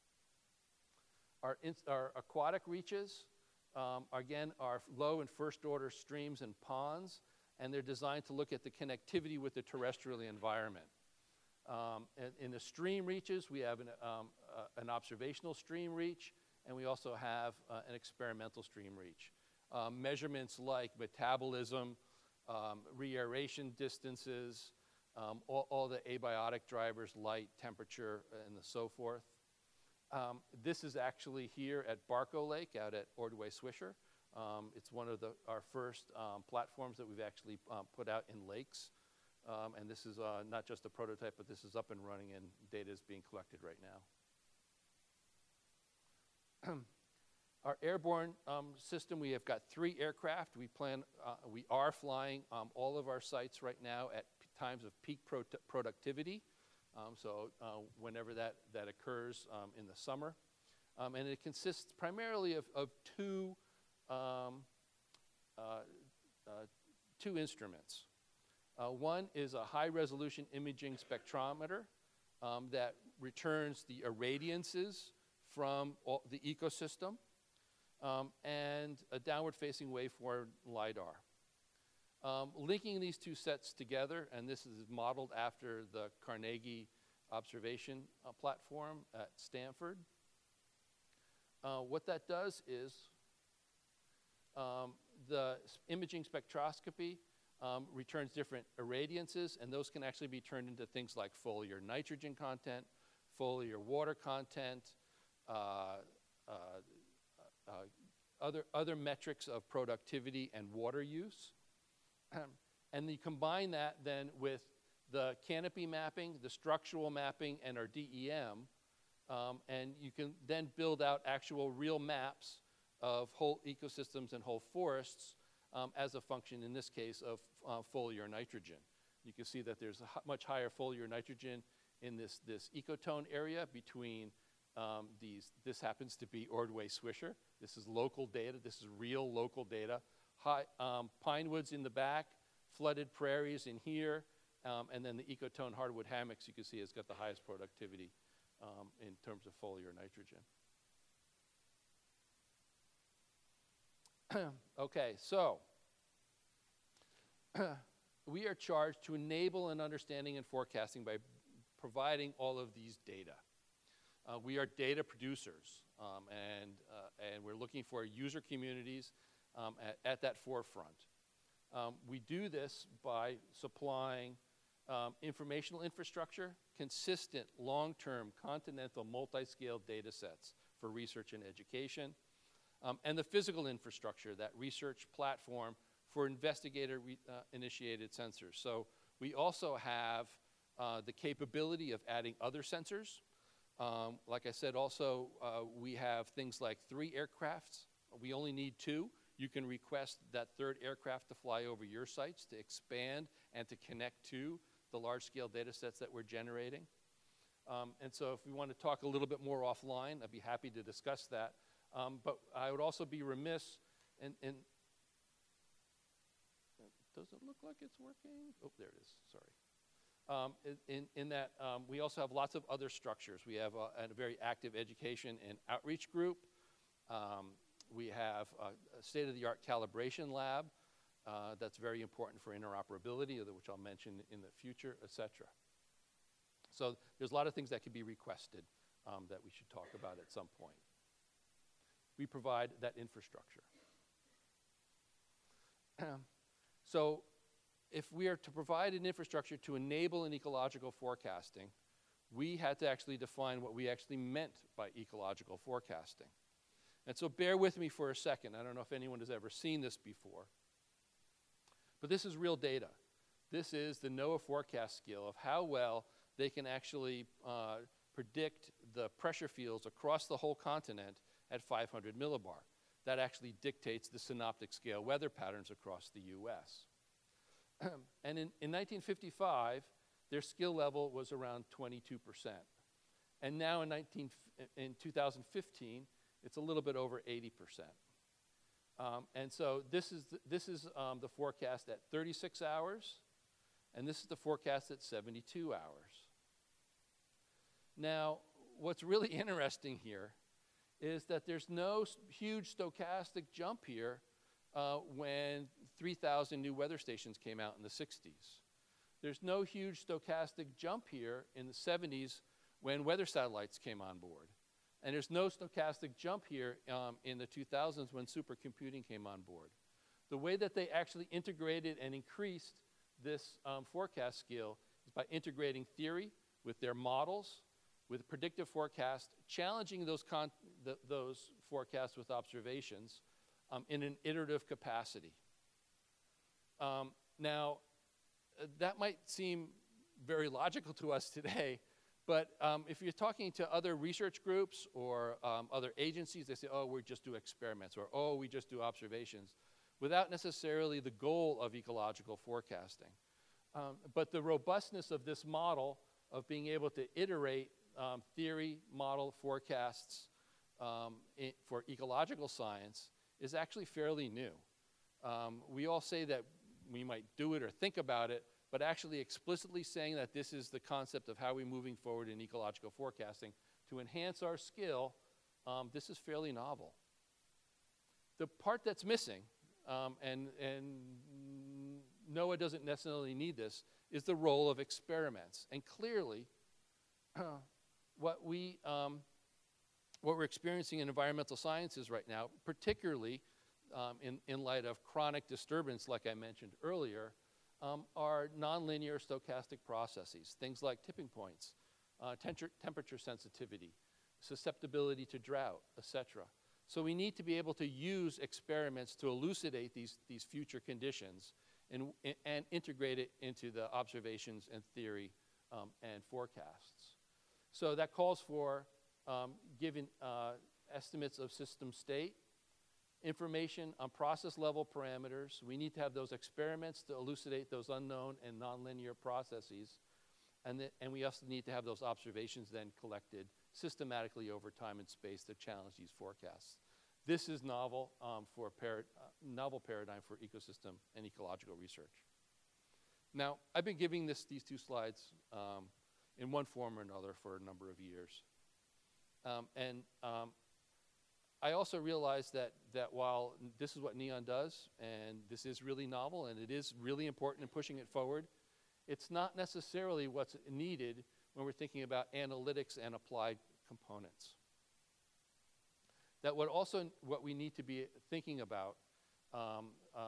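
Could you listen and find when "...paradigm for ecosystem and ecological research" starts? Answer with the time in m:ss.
7:19.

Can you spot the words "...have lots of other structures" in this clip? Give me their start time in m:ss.
3:42.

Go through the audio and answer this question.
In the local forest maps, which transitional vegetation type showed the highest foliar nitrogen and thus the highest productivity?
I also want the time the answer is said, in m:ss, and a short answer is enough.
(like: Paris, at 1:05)
hardwood hammocks, at 2:25.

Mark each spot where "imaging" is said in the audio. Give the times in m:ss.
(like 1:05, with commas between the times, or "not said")
1:10, 1:35.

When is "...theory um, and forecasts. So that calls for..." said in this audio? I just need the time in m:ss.
6:54.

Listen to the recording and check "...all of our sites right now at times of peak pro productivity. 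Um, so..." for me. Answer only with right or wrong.
right.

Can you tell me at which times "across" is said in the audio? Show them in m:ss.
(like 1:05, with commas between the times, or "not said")
4:29, 4:35.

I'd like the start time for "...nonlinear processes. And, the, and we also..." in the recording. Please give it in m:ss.
7:08.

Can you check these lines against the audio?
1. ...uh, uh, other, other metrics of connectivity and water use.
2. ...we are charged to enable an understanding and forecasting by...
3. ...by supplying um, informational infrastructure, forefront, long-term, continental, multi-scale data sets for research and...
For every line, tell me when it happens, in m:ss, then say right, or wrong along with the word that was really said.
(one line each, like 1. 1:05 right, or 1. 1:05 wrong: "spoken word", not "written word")
1. 1:46 wrong: "productivity", not "connectivity"
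2. 2:38 right
3. 2:53 wrong: "consistent", not "forefront".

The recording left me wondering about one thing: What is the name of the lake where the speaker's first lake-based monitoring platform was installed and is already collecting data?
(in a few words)
Barco Lake.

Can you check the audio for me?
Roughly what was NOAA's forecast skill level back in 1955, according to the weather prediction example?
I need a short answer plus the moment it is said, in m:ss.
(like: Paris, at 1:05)
22%, at 4:41.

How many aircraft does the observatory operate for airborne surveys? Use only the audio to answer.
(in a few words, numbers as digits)
3.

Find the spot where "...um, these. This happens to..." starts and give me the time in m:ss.
2:14.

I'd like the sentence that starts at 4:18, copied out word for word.
I don't know if anyone has ever seen this before, but this is real data.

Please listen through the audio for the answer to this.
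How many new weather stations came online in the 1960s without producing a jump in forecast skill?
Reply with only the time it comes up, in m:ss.
5:05.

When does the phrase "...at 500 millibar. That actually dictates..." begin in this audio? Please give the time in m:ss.
4:31.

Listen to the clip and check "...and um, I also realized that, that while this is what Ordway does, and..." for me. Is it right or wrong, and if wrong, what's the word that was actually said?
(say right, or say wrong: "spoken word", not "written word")
wrong: "Neon", not "Ordway".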